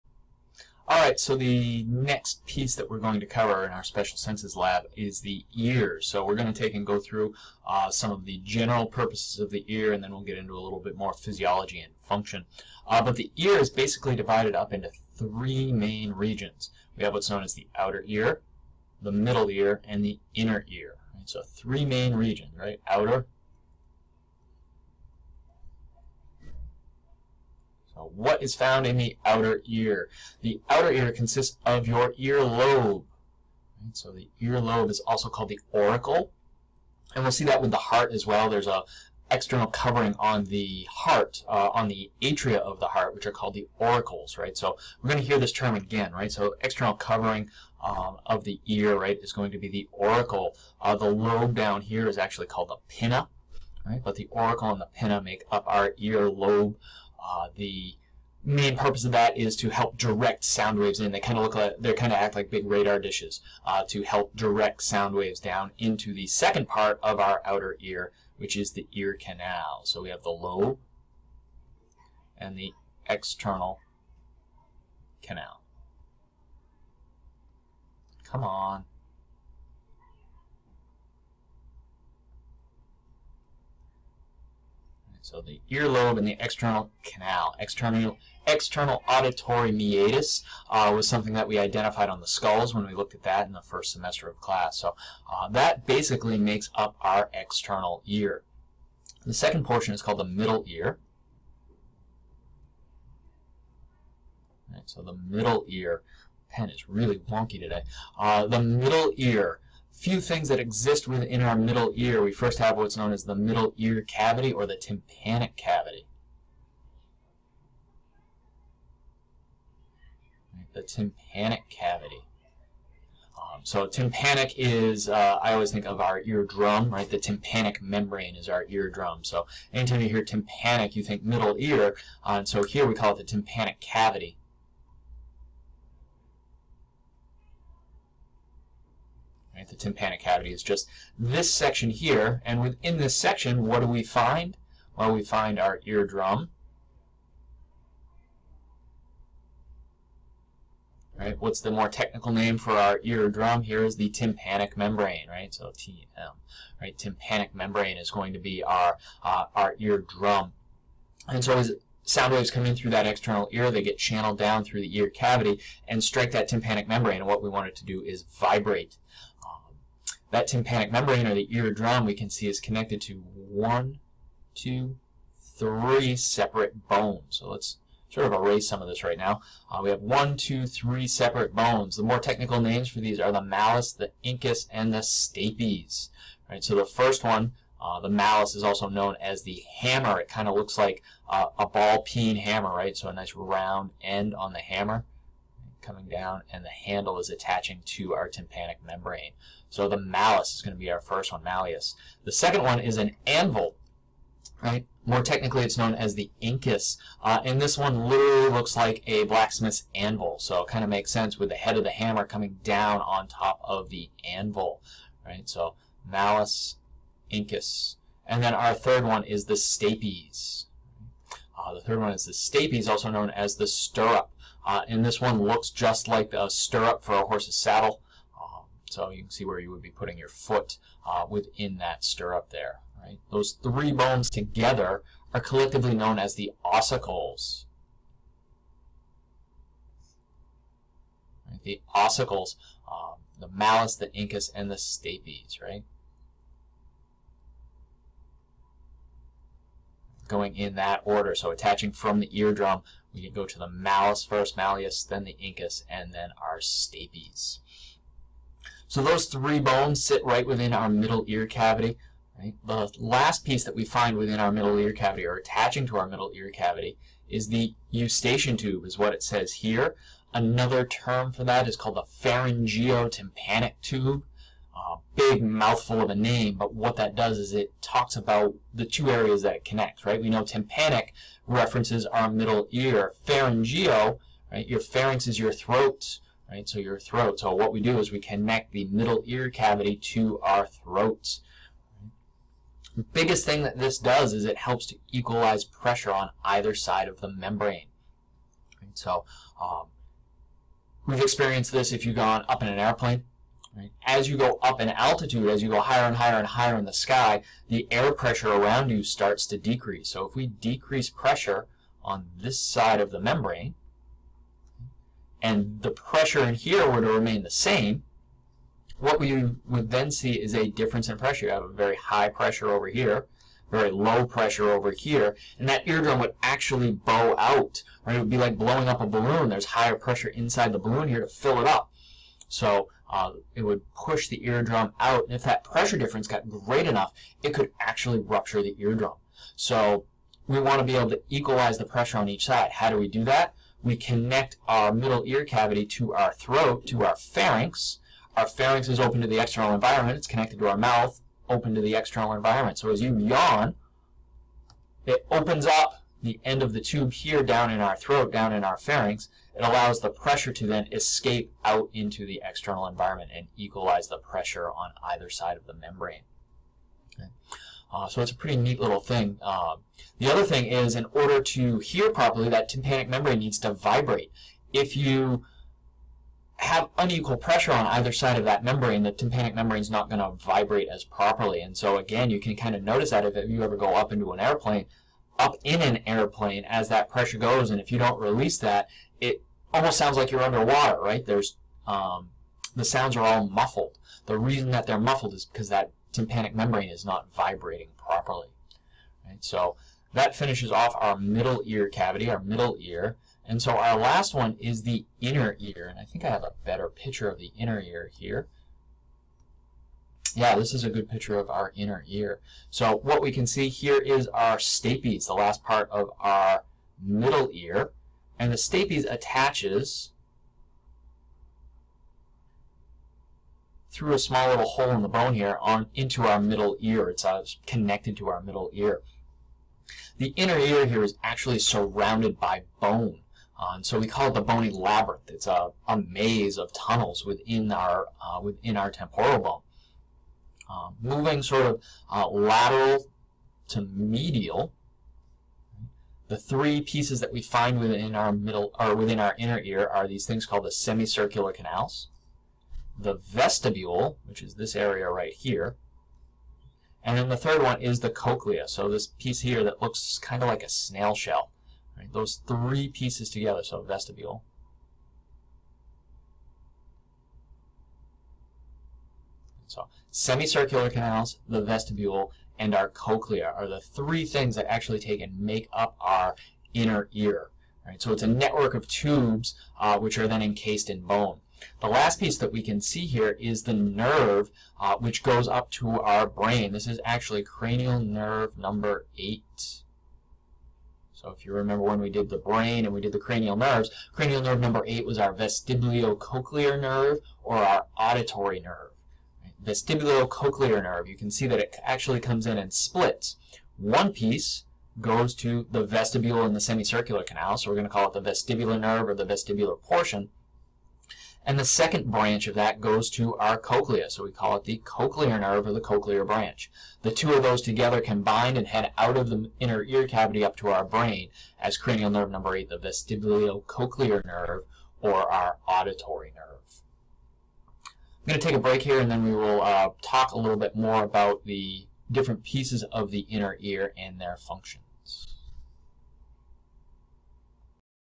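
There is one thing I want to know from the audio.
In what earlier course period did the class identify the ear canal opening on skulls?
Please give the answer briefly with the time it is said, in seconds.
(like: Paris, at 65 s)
first semester, at 93 s.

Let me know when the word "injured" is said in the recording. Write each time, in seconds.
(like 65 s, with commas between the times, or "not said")
not said.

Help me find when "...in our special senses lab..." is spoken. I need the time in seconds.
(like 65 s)
3 s.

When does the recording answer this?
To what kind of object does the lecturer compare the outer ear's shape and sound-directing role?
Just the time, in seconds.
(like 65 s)
62 s.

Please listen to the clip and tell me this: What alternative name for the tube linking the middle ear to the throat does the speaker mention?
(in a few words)
pharyngeotympanic tube.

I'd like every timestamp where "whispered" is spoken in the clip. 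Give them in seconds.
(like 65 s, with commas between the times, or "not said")
not said.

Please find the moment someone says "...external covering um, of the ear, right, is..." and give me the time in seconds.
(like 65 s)
46 s.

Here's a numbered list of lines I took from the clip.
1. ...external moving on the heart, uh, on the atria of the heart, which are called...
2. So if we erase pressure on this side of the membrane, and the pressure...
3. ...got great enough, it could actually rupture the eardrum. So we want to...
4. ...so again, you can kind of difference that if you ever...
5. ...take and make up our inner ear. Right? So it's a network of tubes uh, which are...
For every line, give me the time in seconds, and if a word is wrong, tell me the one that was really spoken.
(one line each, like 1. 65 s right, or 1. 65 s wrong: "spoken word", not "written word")
1. 39 s wrong: "covering", not "moving"
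2. 310 s wrong: "decrease", not "erase"
3. 336 s right
4. 381 s wrong: "notice", not "difference"
5. 474 s right.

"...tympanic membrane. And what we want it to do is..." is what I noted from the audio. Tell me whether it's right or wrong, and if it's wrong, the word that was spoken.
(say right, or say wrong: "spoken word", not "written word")
right.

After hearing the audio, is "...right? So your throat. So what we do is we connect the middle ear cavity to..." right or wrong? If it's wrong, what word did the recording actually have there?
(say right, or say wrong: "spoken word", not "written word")
right.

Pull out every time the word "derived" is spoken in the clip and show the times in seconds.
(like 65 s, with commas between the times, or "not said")
not said.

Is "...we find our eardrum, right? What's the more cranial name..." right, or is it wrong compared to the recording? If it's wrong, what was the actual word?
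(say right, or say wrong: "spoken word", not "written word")
wrong: "technical", not "cranial".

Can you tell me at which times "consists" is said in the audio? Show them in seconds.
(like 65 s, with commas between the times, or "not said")
31 s.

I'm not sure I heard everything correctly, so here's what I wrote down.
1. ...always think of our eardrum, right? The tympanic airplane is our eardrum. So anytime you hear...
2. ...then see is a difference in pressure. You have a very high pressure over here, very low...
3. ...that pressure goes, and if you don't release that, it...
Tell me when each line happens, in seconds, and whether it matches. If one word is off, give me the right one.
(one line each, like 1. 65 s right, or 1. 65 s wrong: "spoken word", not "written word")
1. 125 s wrong: "membrane", not "airplane"
2. 319 s right
3. 386 s right.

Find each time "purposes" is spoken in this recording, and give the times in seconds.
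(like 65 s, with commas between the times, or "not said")
8 s, 58 s.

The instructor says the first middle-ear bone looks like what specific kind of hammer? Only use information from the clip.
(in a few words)
ball peen hammer.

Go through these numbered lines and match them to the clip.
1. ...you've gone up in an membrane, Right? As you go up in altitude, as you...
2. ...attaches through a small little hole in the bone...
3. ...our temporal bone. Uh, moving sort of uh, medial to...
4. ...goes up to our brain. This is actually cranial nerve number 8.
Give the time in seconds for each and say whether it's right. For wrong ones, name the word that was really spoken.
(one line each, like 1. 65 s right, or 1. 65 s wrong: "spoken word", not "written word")
1. 302 s wrong: "airplane", not "membrane"
2. 419 s right
3. 438 s wrong: "lateral", not "medial"
4. 485 s right.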